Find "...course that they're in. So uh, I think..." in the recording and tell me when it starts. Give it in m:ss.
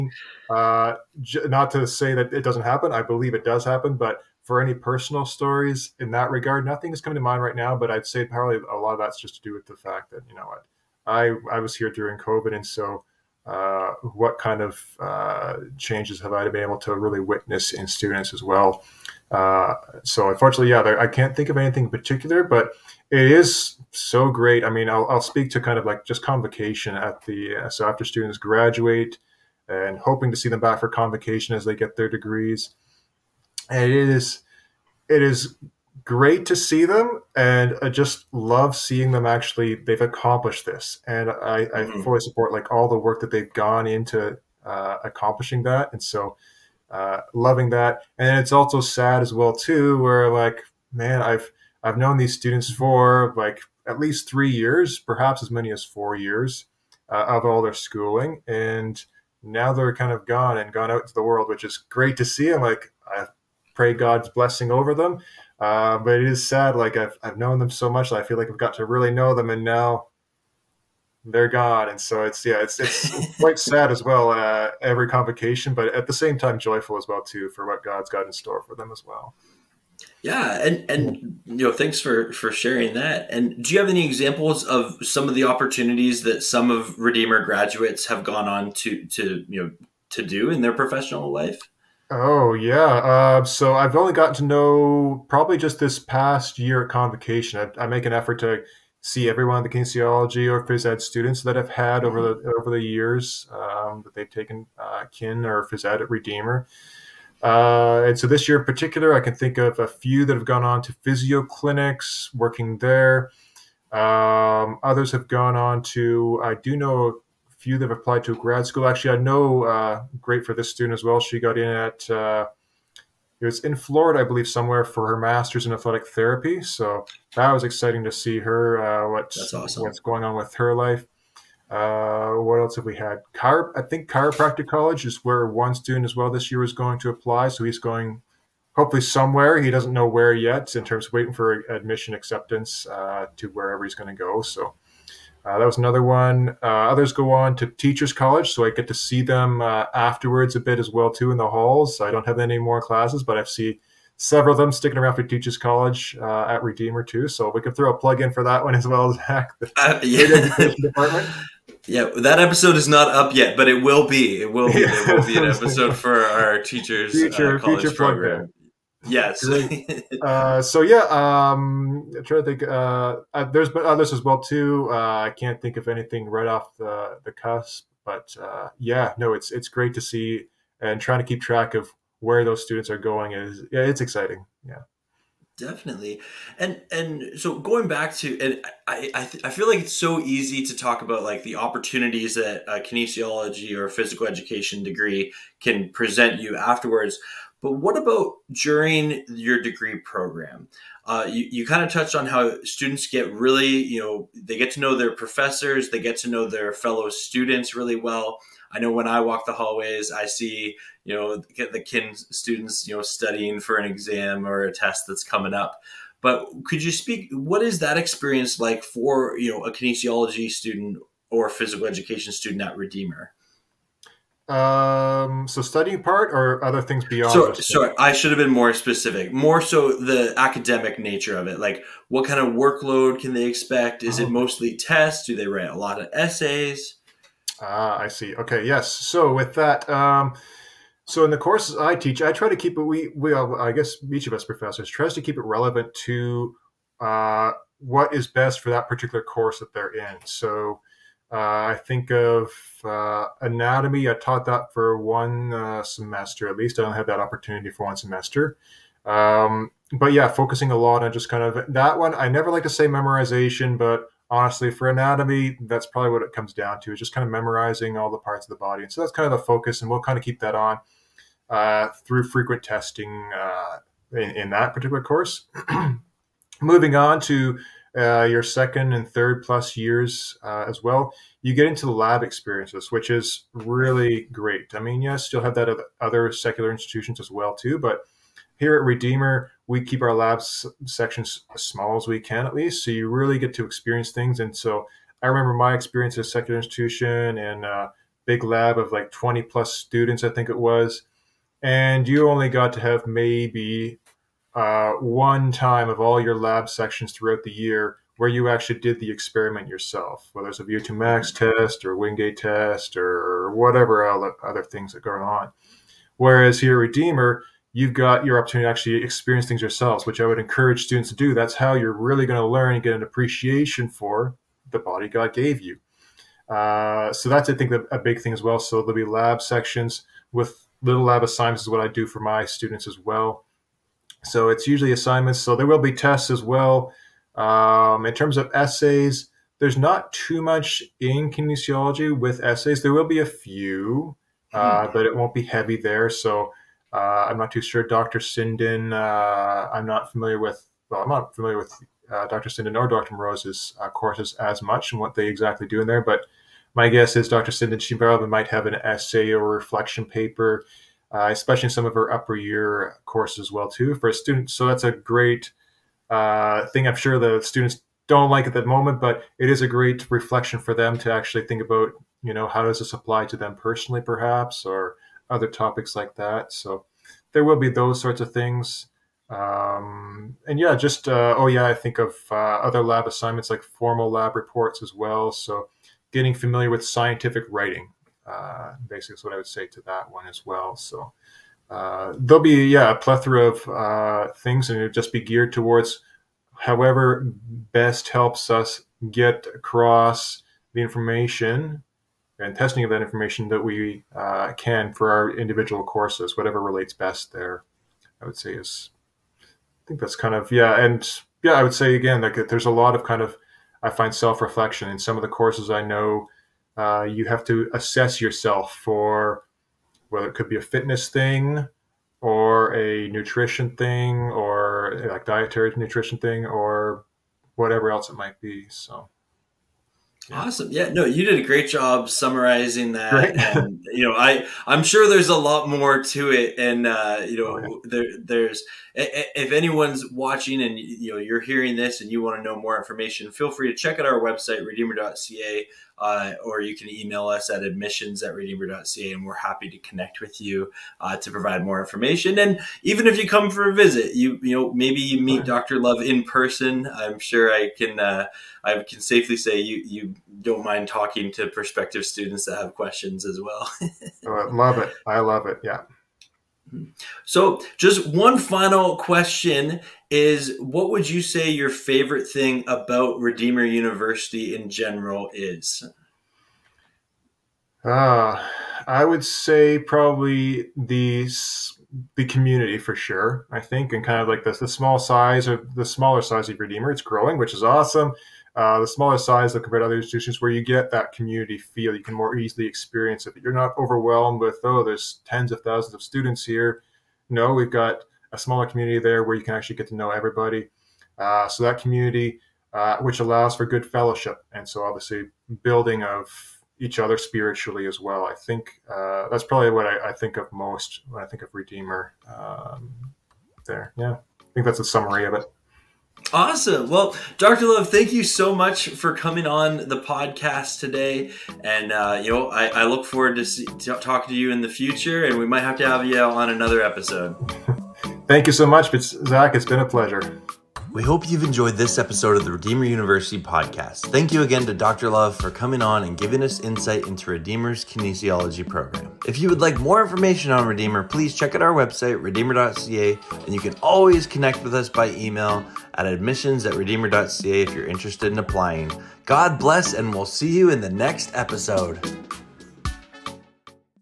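4:09.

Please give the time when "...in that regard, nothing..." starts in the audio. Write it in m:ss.
0:06.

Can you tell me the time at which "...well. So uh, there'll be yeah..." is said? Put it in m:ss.
6:30.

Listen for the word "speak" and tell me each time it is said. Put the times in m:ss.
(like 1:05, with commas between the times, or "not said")
0:25, 3:36.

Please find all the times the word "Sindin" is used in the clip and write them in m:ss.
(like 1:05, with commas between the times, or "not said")
5:48, 5:52, 5:57.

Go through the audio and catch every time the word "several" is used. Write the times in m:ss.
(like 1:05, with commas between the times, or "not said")
2:34.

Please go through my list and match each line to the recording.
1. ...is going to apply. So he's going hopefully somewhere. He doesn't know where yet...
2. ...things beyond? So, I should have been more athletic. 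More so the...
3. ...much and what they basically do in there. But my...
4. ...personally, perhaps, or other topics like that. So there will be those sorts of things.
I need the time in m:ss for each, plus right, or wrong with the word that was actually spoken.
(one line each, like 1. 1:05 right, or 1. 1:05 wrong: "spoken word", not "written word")
1. 2:16 right
2. 3:46 wrong: "specific", not "athletic"
3. 5:54 wrong: "exactly", not "basically"
4. 6:13 right.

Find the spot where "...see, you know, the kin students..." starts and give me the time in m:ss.
3:30.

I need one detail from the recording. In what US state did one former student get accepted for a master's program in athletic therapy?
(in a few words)
Florida.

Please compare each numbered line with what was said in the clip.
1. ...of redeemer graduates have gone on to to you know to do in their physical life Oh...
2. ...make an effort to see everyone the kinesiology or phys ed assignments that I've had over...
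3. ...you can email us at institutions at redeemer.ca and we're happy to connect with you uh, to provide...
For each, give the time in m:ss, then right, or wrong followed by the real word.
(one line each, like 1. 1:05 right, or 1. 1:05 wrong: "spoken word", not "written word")
1. 1:26 wrong: "professional", not "physical"
2. 1:37 wrong: "students", not "assignments"
3. 7:26 wrong: "admissions", not "institutions".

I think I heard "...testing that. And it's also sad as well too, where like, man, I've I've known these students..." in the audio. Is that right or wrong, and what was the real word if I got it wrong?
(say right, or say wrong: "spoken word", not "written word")
wrong: "loving", not "testing".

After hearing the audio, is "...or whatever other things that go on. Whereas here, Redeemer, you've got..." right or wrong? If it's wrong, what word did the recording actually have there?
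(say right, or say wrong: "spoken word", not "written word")
right.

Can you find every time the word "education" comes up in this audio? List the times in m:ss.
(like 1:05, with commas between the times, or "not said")
2:40, 3:14, 3:41.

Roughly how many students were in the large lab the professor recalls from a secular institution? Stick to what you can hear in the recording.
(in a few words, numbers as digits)
20 plus.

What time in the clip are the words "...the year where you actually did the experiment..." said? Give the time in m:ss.
5:07.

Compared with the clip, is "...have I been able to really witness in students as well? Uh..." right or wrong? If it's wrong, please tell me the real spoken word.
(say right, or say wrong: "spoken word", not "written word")
right.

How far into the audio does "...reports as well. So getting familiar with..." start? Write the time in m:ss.
6:24.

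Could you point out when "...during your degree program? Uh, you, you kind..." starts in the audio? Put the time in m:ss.
3:18.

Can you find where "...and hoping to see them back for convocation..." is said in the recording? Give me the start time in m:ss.
0:29.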